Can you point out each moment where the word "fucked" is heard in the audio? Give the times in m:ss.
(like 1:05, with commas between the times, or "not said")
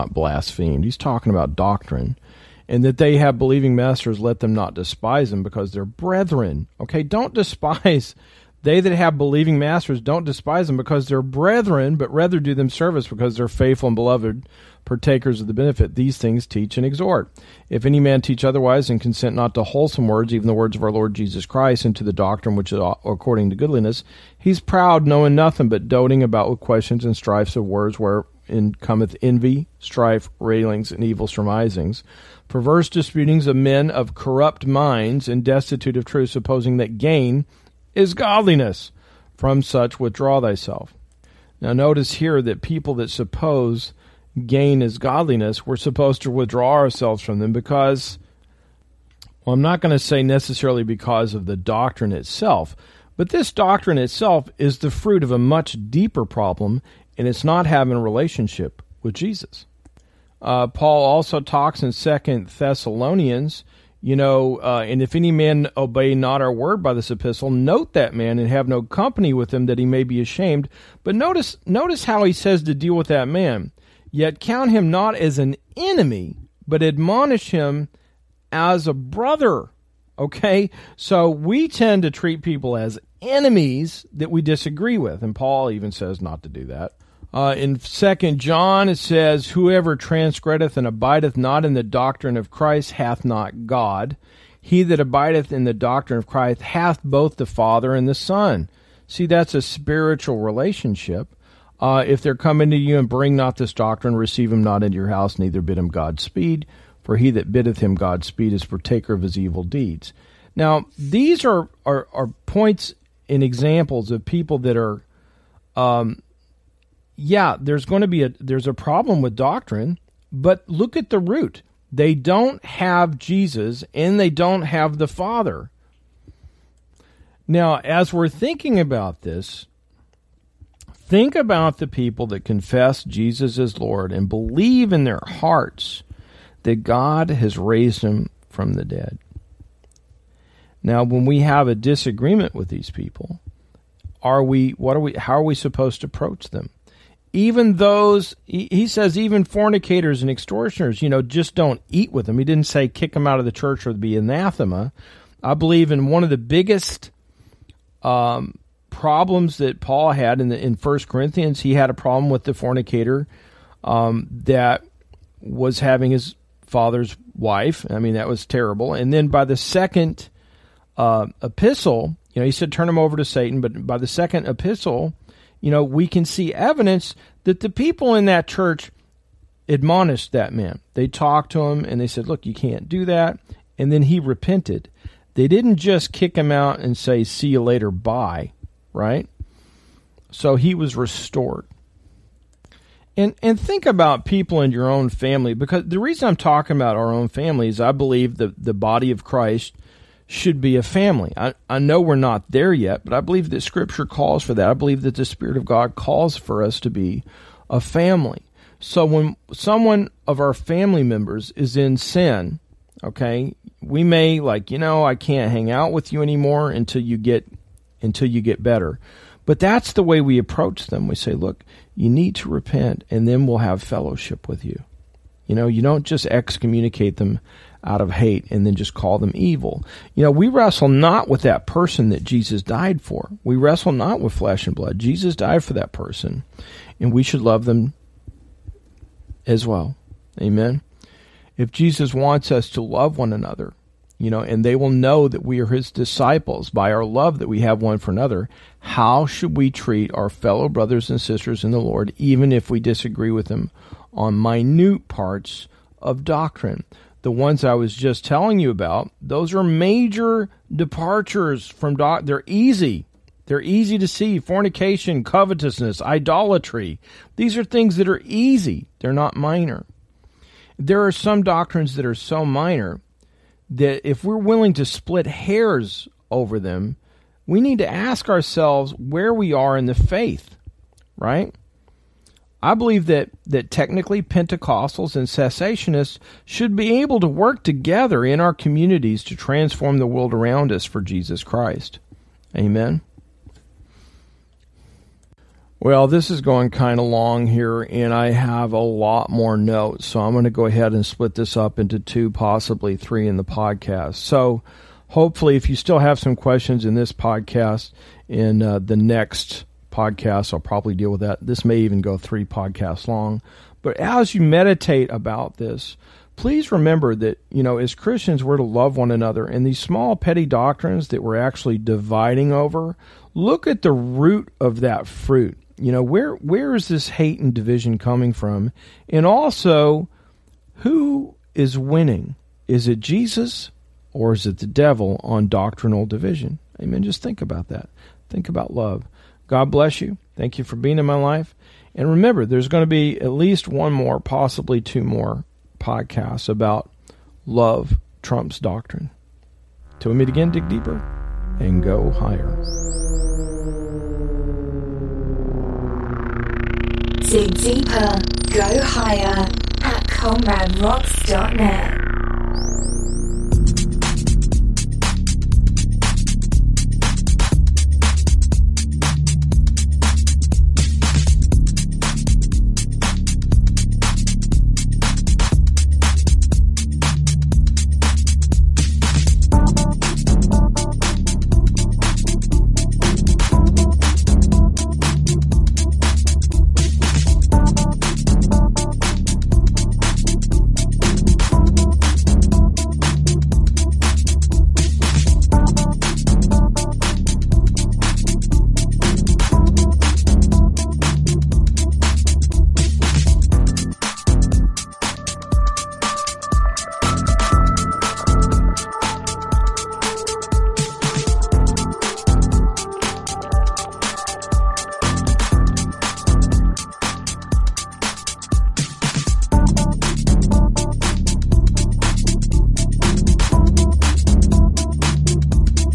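not said.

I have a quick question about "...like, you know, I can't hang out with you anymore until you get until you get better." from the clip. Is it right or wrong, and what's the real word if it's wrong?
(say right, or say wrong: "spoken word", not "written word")
right.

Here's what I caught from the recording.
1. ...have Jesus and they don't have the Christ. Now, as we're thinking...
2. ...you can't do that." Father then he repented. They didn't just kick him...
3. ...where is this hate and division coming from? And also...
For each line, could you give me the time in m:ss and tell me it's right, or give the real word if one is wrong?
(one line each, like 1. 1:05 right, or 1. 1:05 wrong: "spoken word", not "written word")
1. 2:02 wrong: "Father", not "Christ"
2. 3:02 wrong: "And", not "Father"
3. 5:26 right.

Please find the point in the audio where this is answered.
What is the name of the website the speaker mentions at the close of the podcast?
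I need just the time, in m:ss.
6:00.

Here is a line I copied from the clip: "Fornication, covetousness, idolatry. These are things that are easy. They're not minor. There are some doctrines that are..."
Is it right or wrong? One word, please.
right.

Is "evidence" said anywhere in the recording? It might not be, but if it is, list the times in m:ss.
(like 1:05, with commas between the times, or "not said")
2:56.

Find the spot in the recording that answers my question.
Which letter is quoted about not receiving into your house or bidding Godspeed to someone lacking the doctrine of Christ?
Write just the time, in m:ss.
1:27.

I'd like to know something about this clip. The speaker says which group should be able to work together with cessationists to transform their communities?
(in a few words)
Pentecostals.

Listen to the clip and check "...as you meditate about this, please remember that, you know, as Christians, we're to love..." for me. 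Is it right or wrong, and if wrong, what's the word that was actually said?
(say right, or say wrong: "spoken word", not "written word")
right.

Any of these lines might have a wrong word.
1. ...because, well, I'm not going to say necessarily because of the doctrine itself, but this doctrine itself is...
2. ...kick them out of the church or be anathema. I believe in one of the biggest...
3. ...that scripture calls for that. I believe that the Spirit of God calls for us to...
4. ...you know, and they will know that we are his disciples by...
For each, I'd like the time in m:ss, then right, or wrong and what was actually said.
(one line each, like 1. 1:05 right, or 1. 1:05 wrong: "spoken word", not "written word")
1. 0:47 right
2. 2:32 right
3. 3:23 right
4. 4:04 right.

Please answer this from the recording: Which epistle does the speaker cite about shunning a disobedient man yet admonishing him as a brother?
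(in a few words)
Second Thessalonians.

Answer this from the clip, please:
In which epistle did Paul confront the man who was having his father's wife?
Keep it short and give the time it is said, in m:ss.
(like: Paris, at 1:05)
First Corinthians, at 2:40.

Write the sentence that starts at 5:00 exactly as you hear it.
So I'm going to go ahead and split this up into two, possibly three in the podcast.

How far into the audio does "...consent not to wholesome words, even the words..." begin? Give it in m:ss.
0:18.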